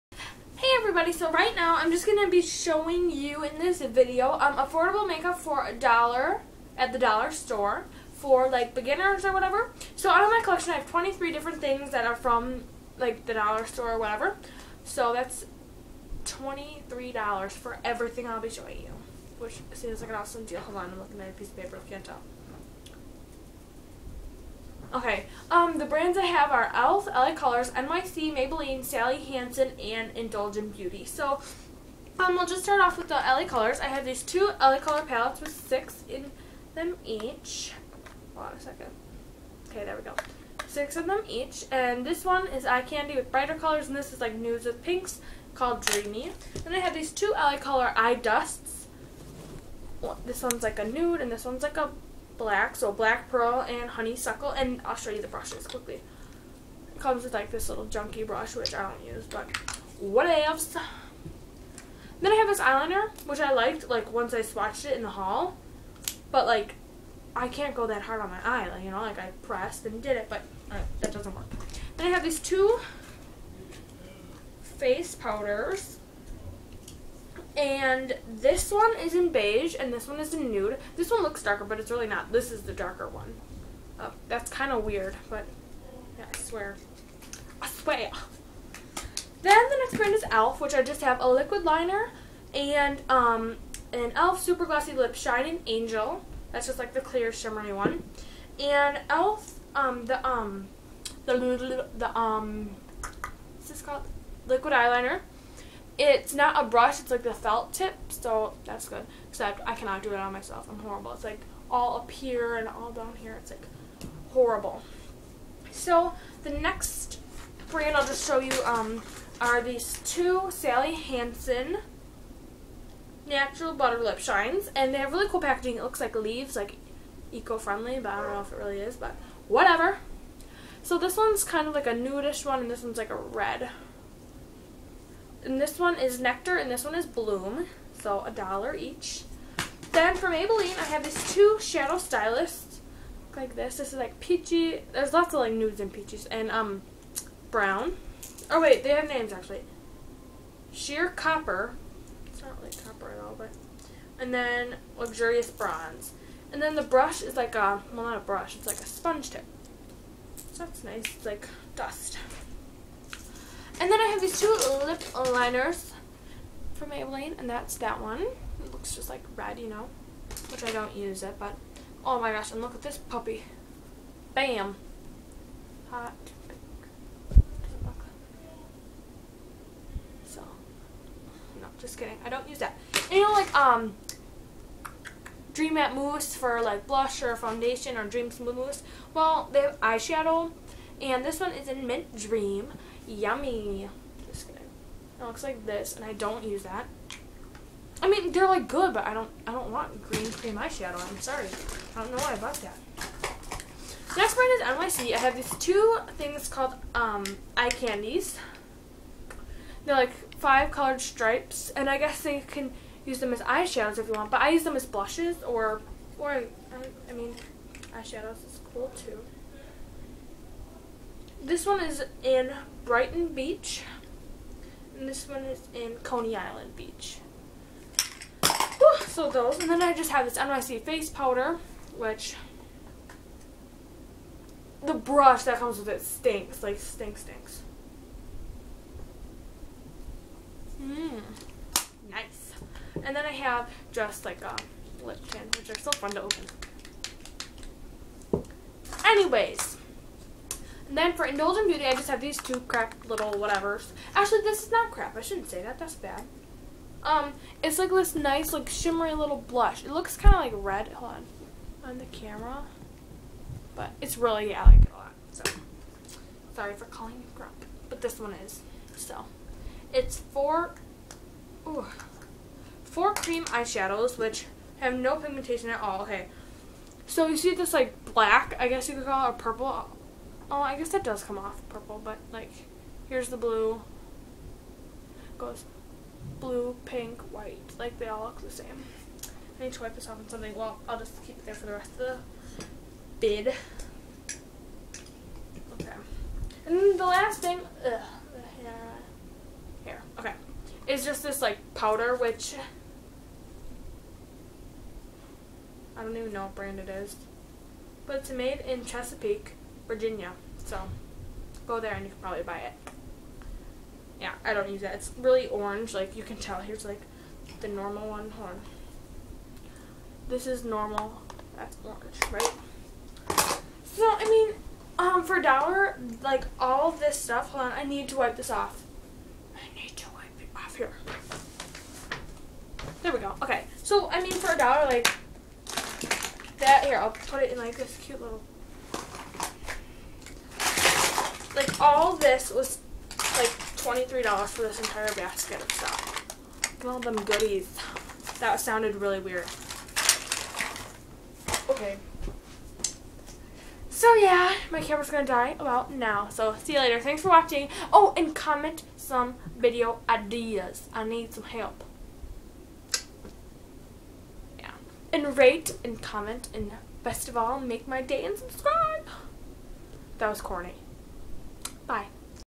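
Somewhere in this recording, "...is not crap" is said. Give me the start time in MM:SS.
04:14.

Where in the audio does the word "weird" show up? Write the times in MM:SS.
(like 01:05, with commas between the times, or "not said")
01:24, 05:49.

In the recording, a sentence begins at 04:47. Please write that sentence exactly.
Like, they all look the same.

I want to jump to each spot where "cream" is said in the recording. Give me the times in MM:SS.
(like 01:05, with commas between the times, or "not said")
03:20, 04:33.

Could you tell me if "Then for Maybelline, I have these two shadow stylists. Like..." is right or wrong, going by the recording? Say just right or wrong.
right.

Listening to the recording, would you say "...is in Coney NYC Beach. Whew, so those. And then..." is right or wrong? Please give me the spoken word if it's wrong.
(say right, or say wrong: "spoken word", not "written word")
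wrong: "Island", not "NYC".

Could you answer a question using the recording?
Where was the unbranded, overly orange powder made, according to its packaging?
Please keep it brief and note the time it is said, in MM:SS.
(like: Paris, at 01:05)
Chesapeake, Virginia, at 05:08.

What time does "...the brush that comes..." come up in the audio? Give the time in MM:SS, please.
03:54.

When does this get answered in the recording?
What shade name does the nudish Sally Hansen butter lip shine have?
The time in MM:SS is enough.
02:16.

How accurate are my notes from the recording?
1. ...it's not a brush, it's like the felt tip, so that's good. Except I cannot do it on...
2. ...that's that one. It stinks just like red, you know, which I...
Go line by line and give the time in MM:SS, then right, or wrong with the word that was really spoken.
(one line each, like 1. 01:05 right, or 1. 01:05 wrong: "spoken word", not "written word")
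1. 01:46 right
2. 02:47 wrong: "looks", not "stinks".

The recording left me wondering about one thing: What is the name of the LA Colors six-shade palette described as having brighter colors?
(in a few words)
Eye Candy.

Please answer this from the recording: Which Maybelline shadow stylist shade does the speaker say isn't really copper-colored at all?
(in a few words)
Sheer copper.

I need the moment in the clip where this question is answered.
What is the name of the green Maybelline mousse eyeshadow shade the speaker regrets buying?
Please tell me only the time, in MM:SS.
03:11.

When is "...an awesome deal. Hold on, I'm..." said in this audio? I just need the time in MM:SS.
00:20.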